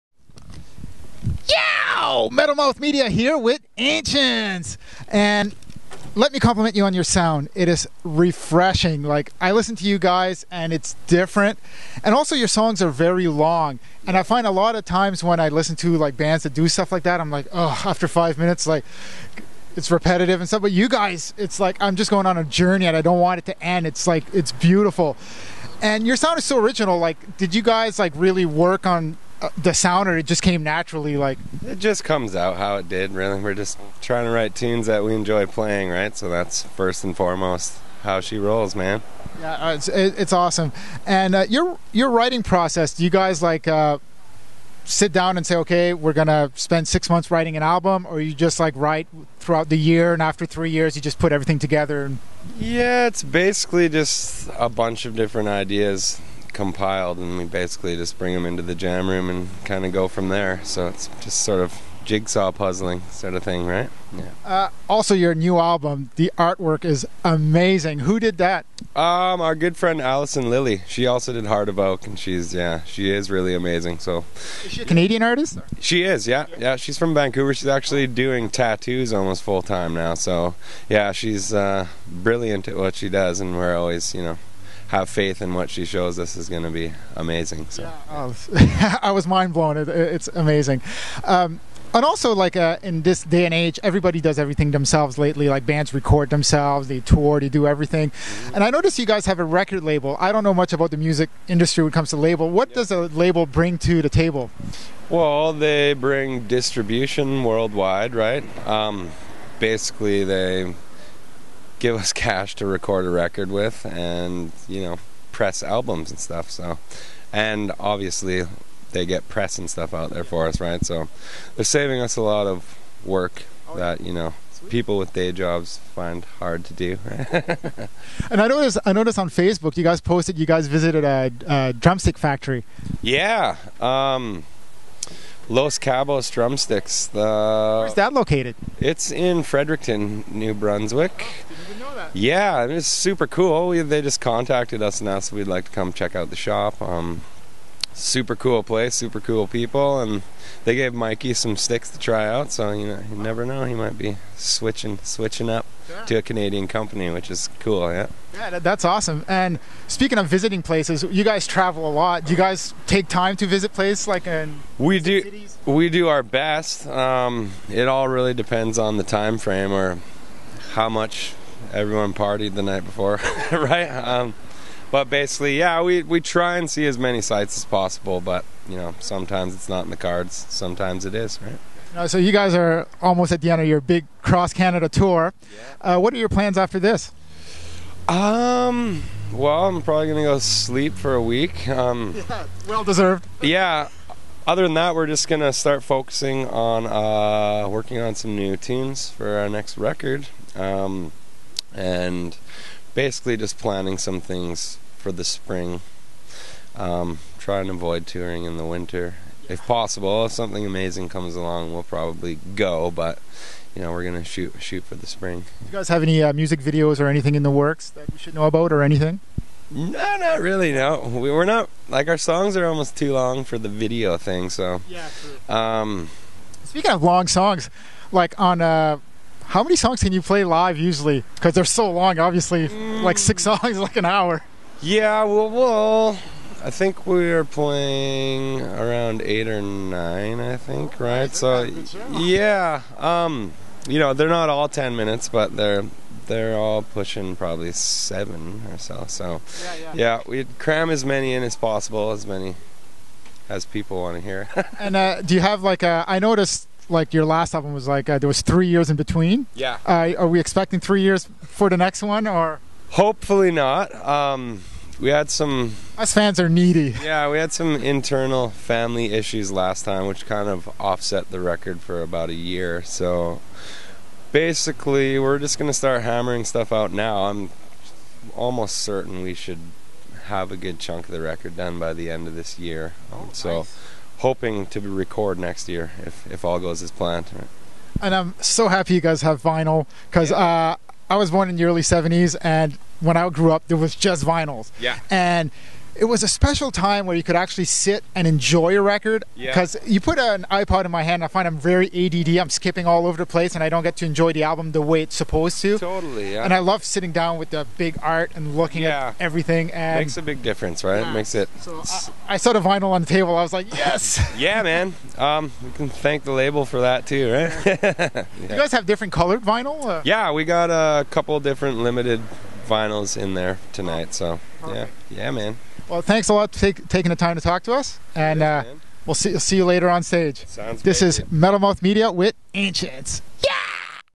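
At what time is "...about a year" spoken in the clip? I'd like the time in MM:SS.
04:32.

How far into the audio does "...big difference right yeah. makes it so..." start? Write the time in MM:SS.
05:10.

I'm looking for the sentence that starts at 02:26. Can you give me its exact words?
Um, super cool place, super cool people, and they gave Mikey some sticks to try out.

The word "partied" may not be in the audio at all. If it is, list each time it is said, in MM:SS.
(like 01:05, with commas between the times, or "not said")
02:52.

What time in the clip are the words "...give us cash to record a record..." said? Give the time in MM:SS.
01:51.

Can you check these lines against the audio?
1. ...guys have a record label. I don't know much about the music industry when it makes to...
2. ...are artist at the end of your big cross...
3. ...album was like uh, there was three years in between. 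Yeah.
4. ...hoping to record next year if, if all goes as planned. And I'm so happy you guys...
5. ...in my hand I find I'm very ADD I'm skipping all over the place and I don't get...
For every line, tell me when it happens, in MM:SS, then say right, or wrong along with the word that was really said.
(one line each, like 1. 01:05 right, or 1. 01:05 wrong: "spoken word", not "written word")
1. 01:39 wrong: "comes", not "makes"
2. 03:02 wrong: "almost", not "artist"
3. 04:17 right
4. 04:44 right
5. 05:00 right.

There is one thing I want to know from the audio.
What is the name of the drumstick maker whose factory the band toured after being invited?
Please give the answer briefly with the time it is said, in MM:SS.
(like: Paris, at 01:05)
Los Cabos Drumsticks, at 02:15.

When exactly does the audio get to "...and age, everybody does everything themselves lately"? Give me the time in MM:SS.
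01:33.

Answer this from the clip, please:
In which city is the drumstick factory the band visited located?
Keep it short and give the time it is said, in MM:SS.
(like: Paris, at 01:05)
Fredericton, at 02:19.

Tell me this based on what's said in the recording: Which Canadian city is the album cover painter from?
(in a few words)
Vancouver.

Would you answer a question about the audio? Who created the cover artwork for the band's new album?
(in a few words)
Allison Lilly.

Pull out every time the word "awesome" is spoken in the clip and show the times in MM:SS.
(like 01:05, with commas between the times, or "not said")
00:40, 02:38.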